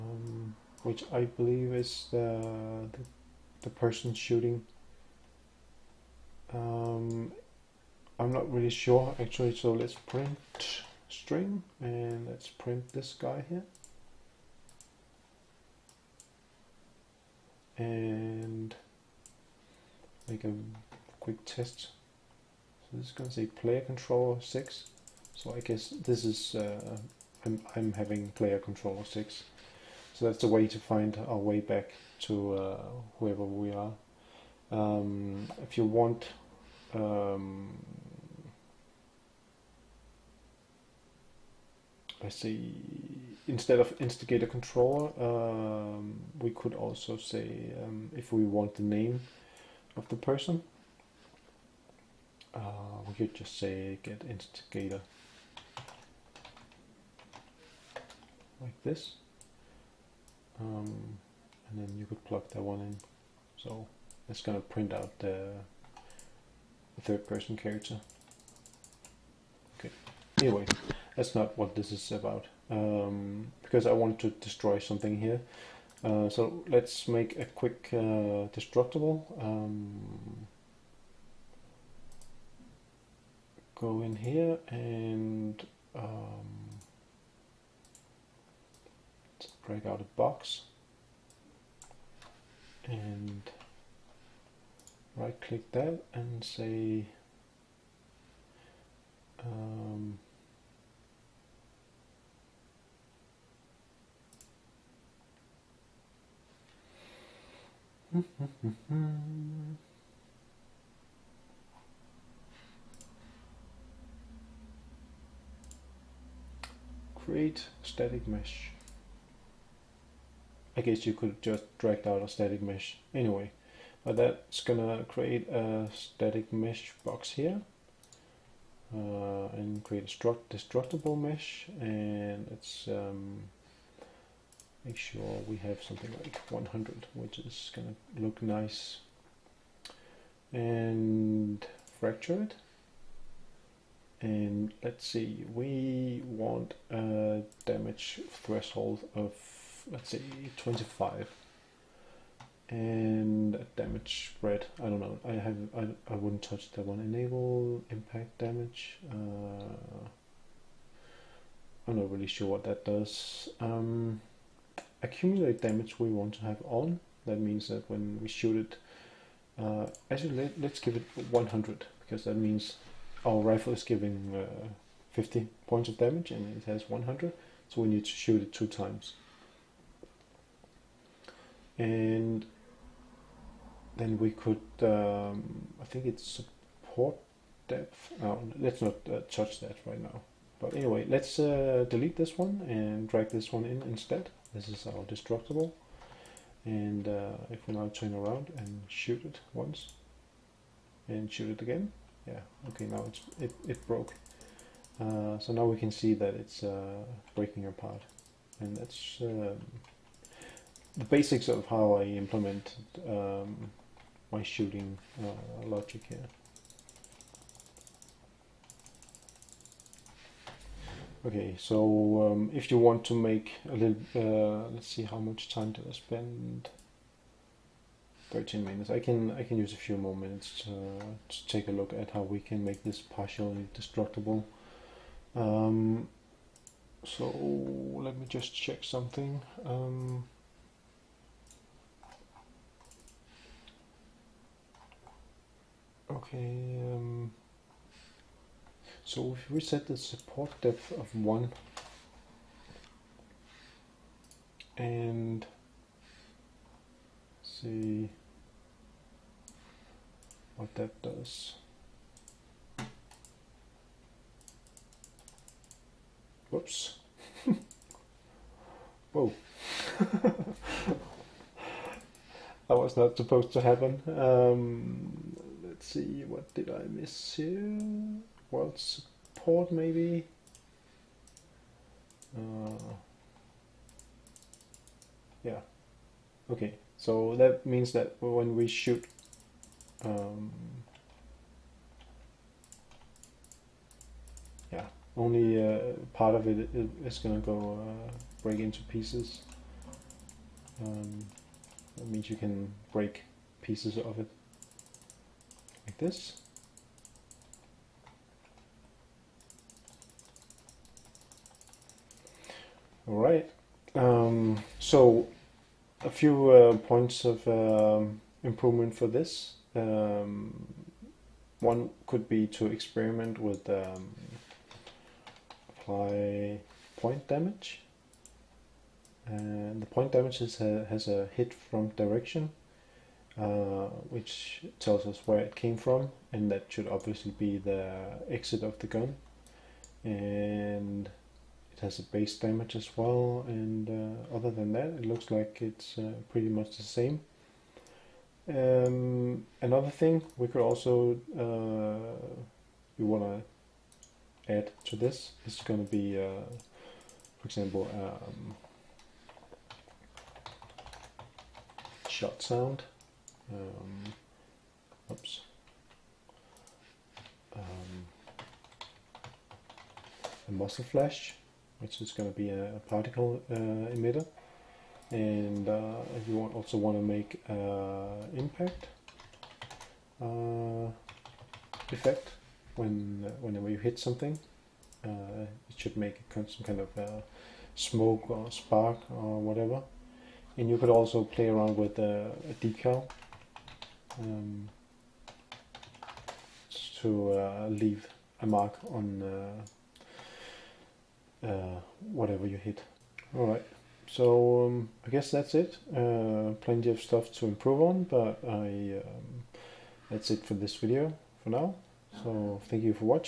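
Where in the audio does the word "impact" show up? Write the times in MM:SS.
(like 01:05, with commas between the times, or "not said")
02:37, 06:18.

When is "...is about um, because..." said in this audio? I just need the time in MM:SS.
01:11.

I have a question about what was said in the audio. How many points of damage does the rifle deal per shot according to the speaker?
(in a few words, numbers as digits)
50.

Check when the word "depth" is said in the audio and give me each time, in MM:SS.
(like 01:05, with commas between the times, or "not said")
03:07, 04:10.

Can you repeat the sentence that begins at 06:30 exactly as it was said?
And you could also play around with a decal um, to uh, leave a mark on uh, uh, whatever you hit.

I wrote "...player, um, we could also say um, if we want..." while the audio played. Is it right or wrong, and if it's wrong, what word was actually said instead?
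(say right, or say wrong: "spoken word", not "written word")
wrong: "controller", not "player".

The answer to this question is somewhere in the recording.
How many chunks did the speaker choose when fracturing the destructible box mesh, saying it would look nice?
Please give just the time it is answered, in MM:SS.
02:16.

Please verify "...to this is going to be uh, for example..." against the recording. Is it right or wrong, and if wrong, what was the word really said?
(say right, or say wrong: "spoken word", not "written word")
right.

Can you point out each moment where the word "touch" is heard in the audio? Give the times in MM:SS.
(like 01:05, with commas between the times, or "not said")
02:36, 03:09.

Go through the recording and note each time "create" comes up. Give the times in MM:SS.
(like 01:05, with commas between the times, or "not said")
01:57, 02:05, 02:09.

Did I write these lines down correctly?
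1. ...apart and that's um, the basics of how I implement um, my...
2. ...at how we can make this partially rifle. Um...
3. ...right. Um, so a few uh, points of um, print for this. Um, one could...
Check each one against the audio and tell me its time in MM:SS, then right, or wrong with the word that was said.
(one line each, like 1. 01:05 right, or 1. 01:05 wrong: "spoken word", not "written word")
1. 03:27 right
2. 03:51 wrong: "destructible", not "rifle"
3. 05:13 wrong: "improvement", not "print".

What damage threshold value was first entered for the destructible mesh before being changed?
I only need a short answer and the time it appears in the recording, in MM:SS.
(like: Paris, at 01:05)
25, at 02:30.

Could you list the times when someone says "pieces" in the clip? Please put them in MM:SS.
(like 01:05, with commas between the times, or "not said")
04:58, 05:03.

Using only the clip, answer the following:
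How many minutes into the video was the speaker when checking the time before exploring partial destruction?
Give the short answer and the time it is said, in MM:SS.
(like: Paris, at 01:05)
13, at 03:48.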